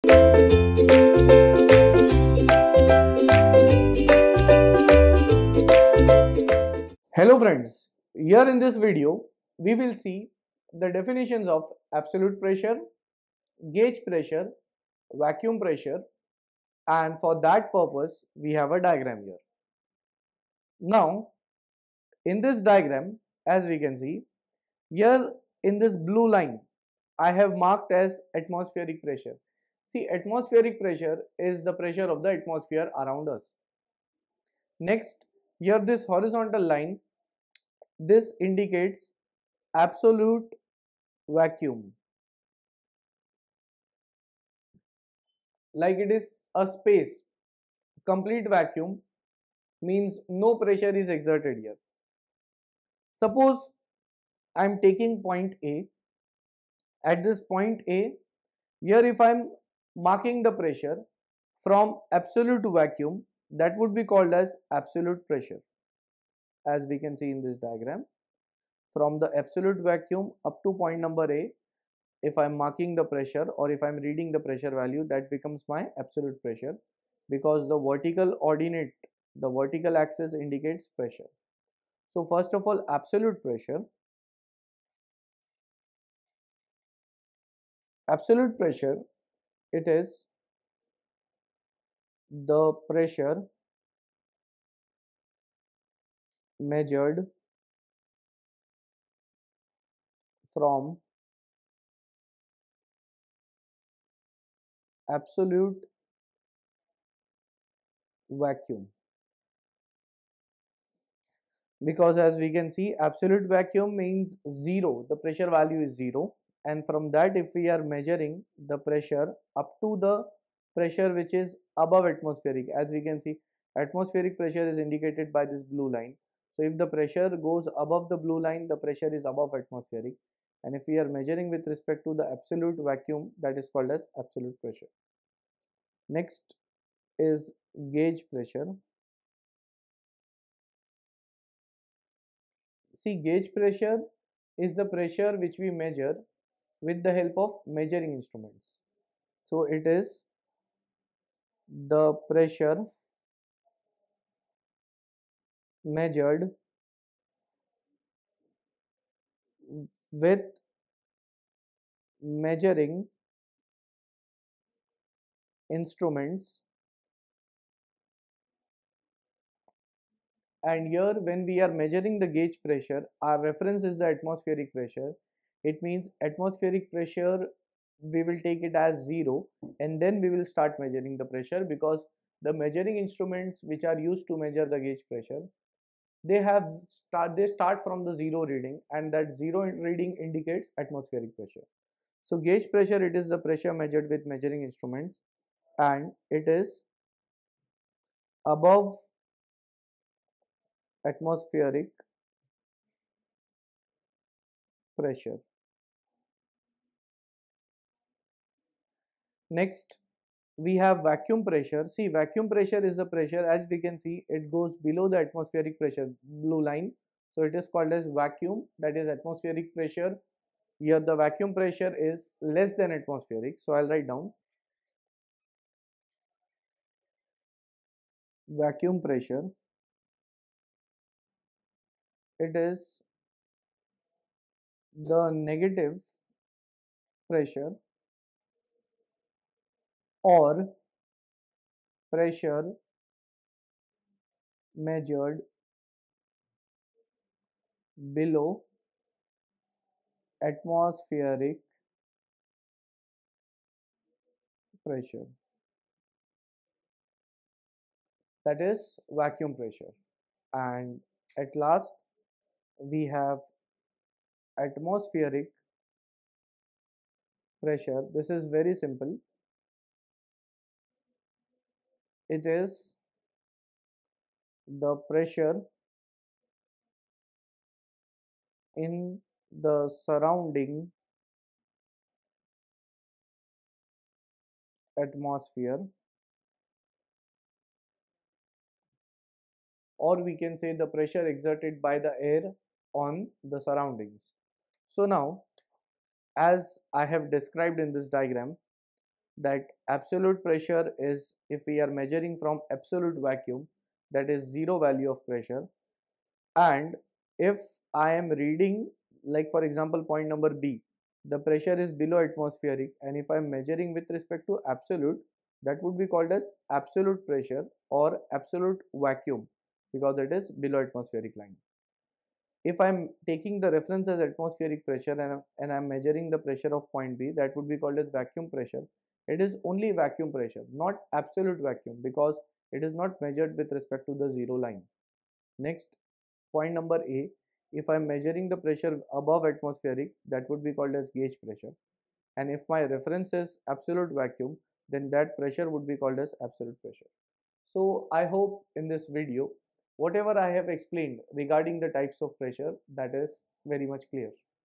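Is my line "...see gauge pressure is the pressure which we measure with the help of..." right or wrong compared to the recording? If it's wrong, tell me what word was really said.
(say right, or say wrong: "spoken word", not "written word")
right.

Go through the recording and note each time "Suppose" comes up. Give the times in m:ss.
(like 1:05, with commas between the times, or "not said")
0:53.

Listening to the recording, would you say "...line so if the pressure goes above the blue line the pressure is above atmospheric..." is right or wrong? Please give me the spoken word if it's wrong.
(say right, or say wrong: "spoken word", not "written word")
right.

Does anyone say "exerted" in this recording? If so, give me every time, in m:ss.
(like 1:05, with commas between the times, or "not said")
0:51, 4:51.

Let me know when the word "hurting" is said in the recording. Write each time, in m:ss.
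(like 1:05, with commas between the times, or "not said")
not said.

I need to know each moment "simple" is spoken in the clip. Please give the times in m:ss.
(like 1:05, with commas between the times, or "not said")
4:28.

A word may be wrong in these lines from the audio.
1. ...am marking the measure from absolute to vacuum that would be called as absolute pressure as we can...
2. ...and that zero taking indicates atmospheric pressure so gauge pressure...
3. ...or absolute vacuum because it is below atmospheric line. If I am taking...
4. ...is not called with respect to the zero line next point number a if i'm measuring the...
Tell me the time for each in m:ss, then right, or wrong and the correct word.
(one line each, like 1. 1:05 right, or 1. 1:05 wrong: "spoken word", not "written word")
1. 0:59 wrong: "pressure", not "measure"
2. 3:08 wrong: "reading", not "taking"
3. 5:17 right
4. 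5:32 wrong: "measured", not "called".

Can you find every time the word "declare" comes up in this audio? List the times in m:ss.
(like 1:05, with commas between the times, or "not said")
not said.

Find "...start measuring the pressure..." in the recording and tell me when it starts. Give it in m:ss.
3:00.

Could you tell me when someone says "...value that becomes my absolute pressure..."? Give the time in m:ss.
1:14.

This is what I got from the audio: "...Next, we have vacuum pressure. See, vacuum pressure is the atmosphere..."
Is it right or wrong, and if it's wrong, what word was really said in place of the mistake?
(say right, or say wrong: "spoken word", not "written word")
wrong: "pressure", not "atmosphere".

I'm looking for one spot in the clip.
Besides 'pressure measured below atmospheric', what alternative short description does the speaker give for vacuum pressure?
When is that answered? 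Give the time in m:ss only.
3:55.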